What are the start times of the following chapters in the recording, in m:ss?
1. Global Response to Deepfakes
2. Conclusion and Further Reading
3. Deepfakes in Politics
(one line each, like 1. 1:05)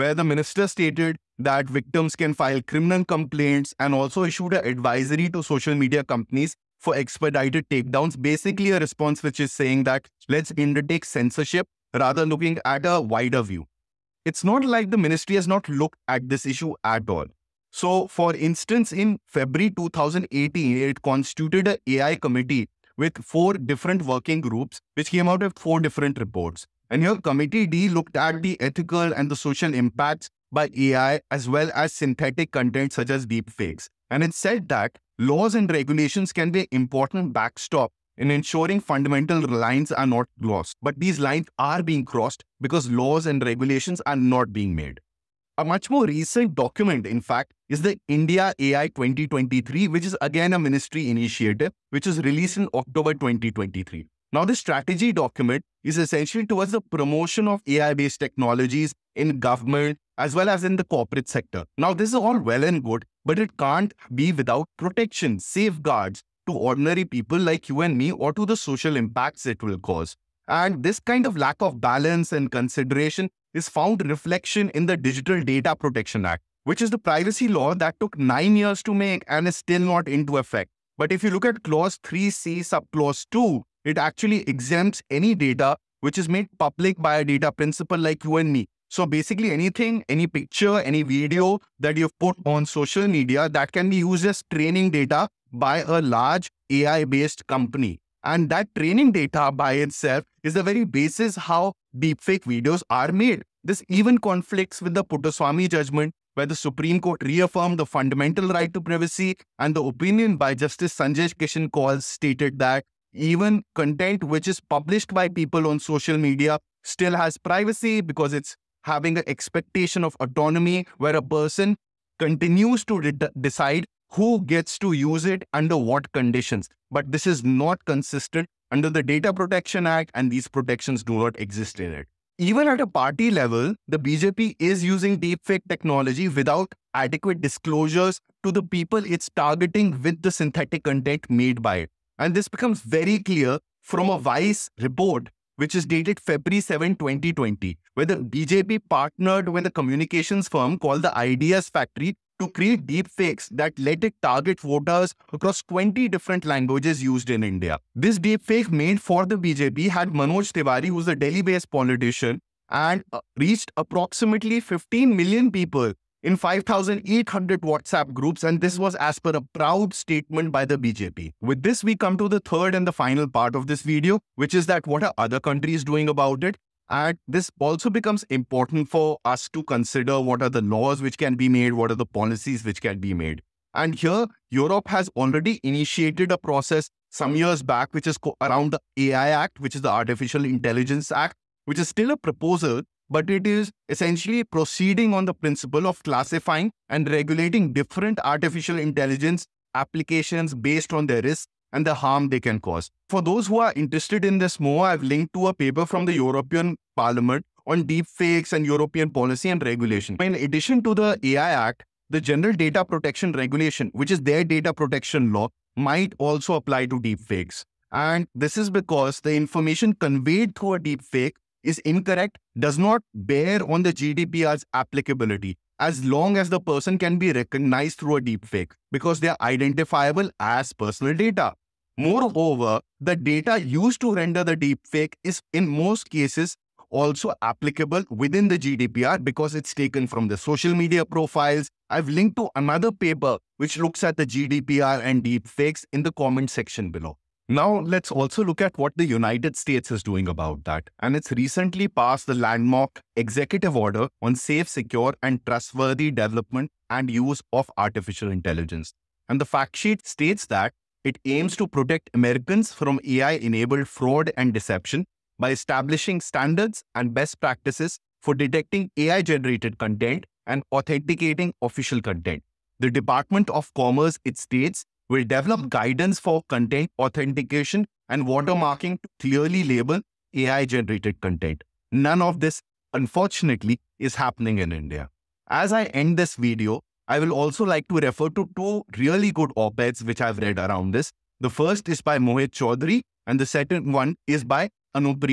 1. 2:50
2. 4:44
3. 2:11.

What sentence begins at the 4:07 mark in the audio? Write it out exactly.
Now, let's also look at what the United States is doing about that.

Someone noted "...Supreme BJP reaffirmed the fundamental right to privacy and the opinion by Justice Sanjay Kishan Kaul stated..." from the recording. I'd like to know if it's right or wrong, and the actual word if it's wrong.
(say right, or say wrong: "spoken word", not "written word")
wrong: "Court", not "BJP".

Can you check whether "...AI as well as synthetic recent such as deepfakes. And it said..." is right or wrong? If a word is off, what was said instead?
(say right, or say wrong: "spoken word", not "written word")
wrong: "content", not "recent".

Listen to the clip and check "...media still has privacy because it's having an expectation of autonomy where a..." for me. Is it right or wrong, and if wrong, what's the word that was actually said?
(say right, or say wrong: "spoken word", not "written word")
right.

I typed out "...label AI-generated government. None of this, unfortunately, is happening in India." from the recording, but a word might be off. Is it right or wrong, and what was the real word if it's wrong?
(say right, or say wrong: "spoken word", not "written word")
wrong: "content", not "government".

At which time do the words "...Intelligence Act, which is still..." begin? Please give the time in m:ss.
3:10.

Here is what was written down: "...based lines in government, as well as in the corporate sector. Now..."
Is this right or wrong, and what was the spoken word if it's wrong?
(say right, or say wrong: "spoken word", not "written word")
wrong: "technologies", not "lines".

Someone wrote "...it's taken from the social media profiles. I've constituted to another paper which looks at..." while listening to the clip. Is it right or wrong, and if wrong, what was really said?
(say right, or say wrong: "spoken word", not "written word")
wrong: "linked", not "constituted".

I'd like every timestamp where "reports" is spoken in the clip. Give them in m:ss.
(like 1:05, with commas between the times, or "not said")
0:26, 2:24.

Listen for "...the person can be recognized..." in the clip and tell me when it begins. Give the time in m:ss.
3:46.